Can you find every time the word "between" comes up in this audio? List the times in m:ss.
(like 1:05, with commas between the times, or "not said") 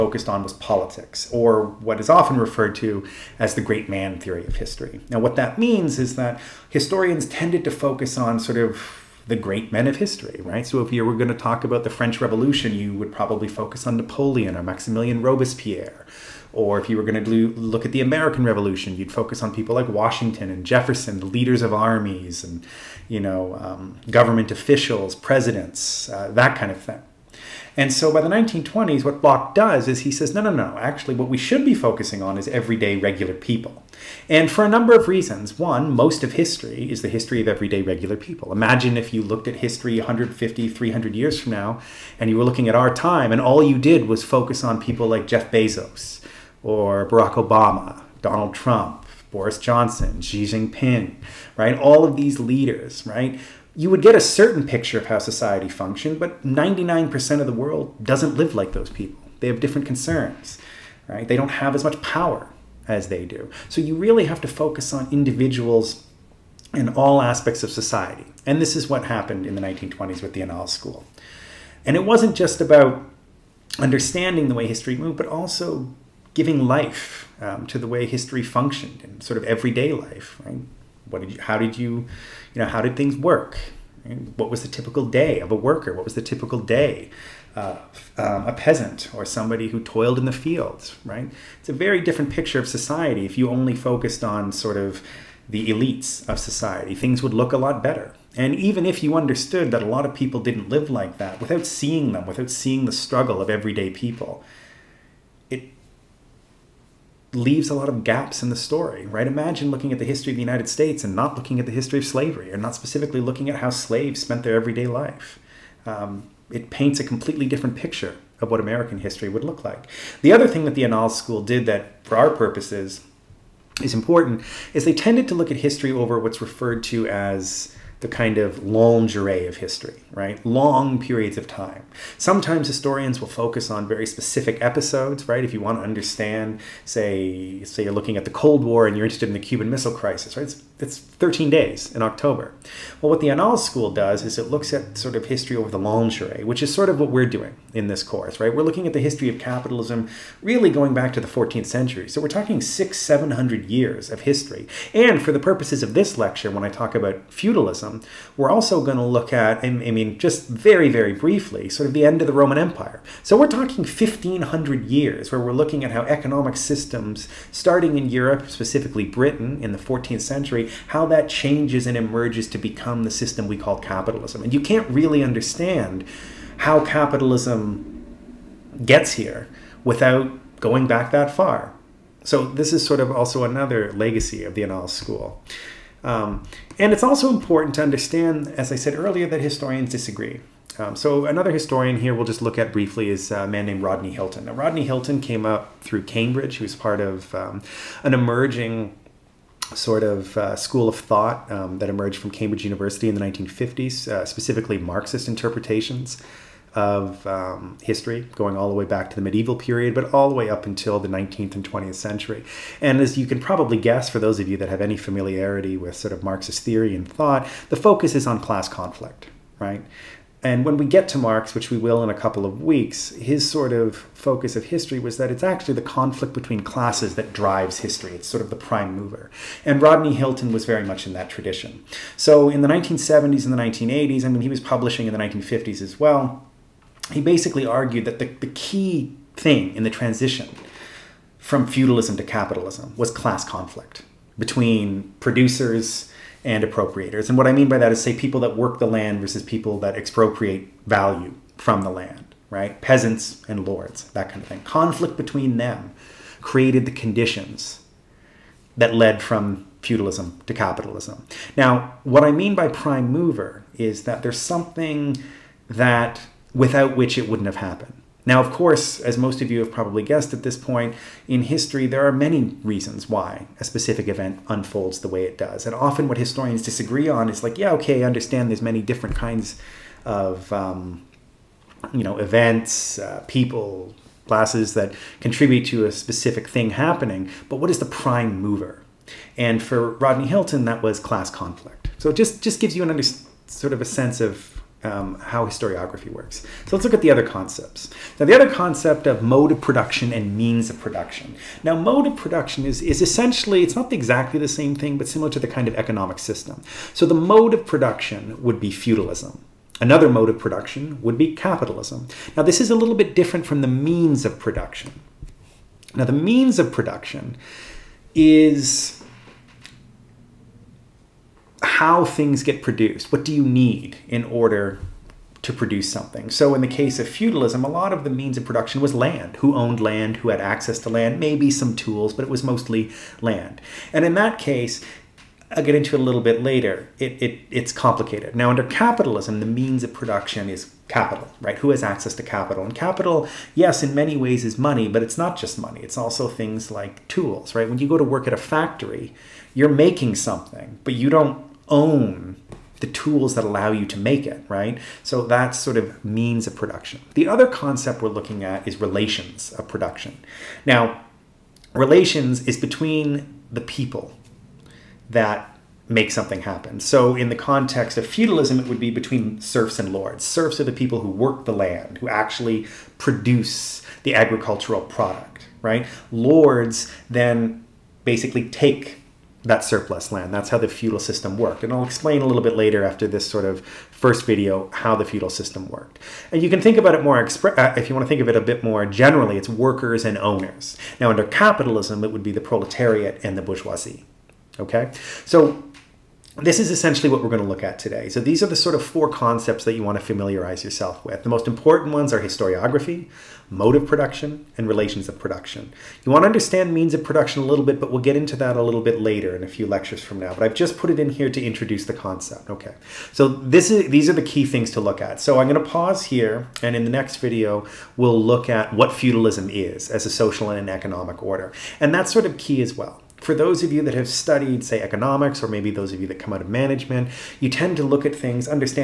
3:46, 4:04, 4:15, 6:02, 6:08.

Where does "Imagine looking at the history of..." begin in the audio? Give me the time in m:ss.
1:49.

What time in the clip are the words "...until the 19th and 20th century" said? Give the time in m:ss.
3:30.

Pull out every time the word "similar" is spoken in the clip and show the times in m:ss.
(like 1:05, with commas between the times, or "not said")
5:05.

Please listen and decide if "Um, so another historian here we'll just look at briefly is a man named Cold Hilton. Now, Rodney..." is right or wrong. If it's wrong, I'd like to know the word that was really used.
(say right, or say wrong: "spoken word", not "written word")
wrong: "Rodney", not "Cold".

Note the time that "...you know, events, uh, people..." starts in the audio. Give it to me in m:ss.
4:41.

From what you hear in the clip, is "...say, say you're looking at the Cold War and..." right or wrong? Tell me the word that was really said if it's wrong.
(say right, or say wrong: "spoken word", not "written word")
right.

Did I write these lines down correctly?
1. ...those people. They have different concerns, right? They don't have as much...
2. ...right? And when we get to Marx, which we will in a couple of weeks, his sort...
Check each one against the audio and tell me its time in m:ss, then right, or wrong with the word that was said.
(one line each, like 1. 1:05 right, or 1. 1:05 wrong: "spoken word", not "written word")
1. 0:58 right
2. 3:39 right.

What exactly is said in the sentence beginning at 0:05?
Now, what that means is that historians tended to focus on sort of the great men of history, right?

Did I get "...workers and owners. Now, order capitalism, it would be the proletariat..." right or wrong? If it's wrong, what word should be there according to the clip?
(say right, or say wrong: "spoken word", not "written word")
wrong: "under", not "order".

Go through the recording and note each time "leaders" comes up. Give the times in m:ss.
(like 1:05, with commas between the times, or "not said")
0:21, 0:52.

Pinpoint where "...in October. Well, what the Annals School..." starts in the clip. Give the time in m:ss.
2:21.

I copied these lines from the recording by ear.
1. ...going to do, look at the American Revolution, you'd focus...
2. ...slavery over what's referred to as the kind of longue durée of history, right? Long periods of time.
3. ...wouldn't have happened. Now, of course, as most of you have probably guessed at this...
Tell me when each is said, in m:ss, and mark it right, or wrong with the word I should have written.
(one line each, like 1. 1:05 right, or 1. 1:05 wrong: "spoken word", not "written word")
1. 0:17 right
2. 2:05 wrong: "history", not "slavery"
3. 4:27 right.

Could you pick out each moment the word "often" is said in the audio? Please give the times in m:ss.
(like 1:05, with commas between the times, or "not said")
0:02, 4:35.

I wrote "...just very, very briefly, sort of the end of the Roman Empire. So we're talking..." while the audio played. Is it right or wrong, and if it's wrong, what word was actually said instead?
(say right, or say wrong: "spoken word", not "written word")
right.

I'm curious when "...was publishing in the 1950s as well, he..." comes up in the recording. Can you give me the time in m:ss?
3:54.